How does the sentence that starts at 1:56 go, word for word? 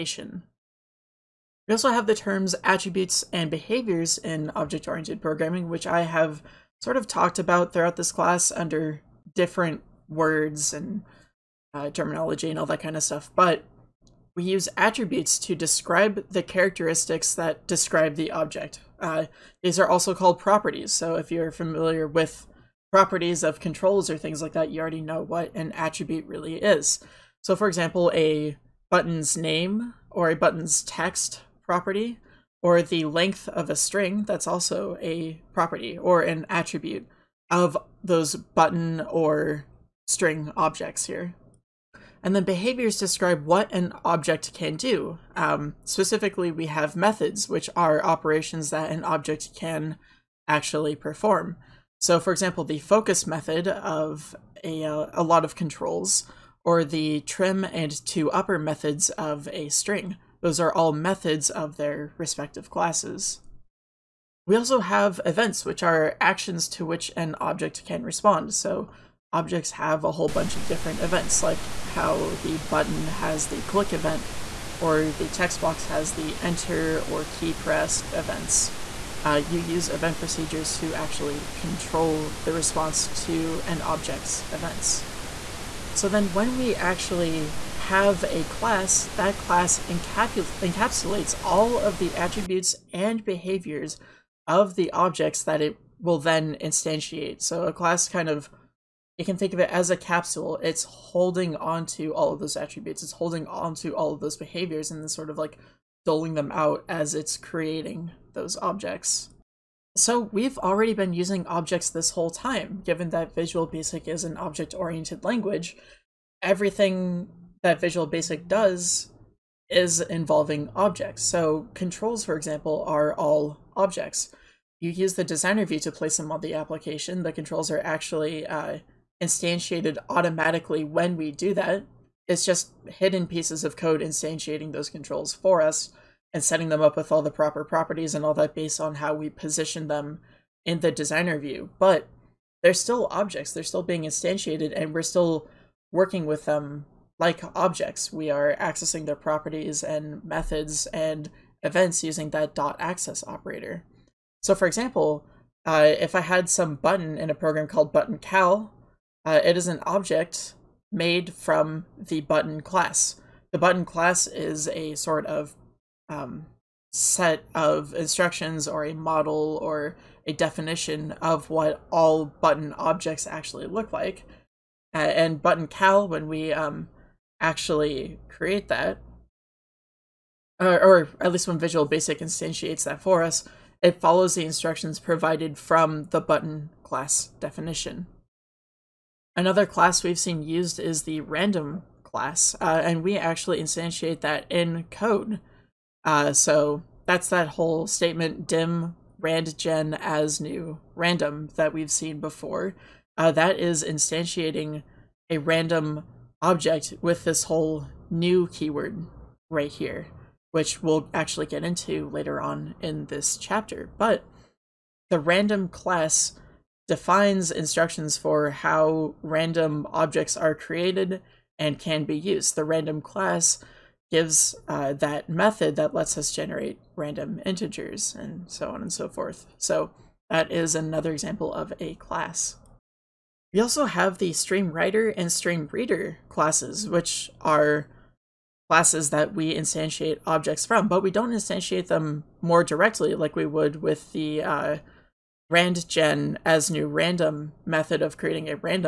Everything that Visual Basic does is involving objects.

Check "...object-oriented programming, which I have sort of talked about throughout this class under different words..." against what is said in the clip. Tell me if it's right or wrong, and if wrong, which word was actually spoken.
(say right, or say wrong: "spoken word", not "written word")
right.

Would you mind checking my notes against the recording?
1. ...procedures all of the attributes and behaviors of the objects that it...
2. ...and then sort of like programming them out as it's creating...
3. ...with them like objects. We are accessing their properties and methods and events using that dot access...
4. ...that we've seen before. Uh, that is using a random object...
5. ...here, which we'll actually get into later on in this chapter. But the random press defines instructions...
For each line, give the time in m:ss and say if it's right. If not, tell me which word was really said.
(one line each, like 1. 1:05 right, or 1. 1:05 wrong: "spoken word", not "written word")
1. 1:29 wrong: "encapsulates", not "procedures"
2. 1:44 wrong: "doling", not "programming"
3. 2:26 right
4. 3:21 wrong: "instantiating", not "using"
5. 3:29 wrong: "class", not "press".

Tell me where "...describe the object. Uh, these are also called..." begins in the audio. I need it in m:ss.
0:17.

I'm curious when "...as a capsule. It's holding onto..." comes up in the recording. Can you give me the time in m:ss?
1:39.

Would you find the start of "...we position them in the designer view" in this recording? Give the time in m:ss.
2:19.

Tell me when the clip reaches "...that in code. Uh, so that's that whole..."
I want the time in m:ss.
3:14.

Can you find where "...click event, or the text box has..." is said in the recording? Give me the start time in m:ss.
1:13.